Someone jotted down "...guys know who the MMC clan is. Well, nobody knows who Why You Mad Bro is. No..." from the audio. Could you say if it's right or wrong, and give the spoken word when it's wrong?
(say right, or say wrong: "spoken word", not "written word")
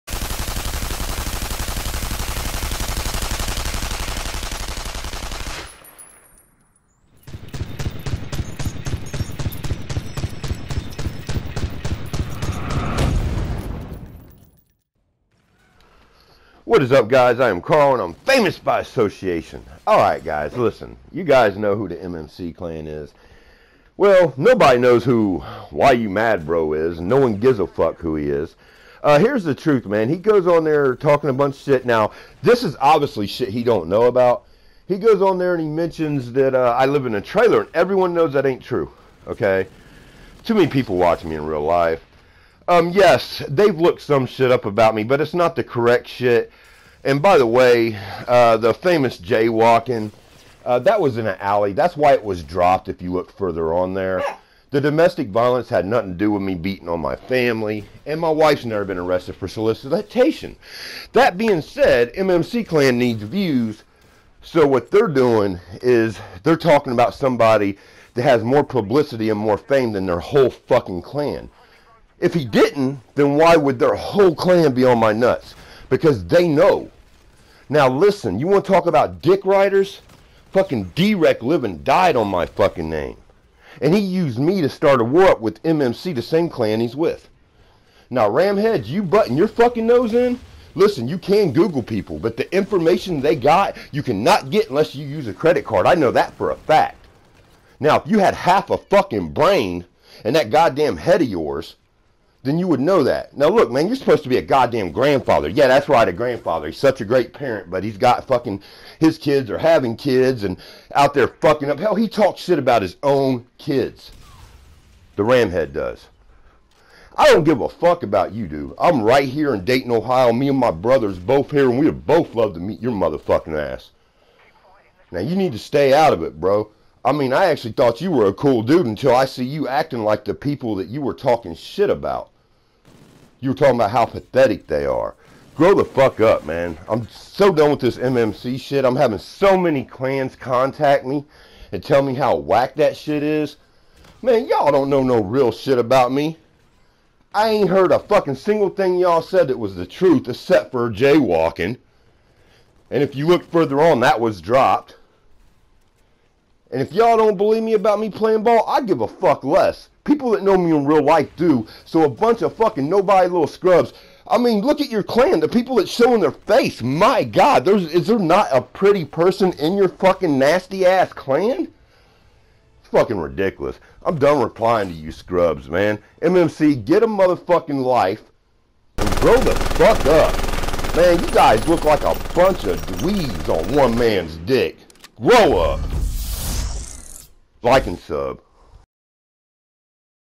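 right.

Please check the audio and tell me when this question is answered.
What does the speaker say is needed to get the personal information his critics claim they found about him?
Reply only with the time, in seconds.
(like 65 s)
95 s.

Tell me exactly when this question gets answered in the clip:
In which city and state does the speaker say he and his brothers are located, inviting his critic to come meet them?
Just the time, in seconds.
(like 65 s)
119 s.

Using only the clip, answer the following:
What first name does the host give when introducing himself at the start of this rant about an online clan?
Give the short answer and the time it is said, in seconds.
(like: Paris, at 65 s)
Carl, at 17 s.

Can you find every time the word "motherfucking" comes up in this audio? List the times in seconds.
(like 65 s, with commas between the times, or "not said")
122 s, 177 s.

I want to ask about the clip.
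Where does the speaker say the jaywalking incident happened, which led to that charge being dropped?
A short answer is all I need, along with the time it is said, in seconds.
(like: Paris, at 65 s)
In an alley, at 51 s.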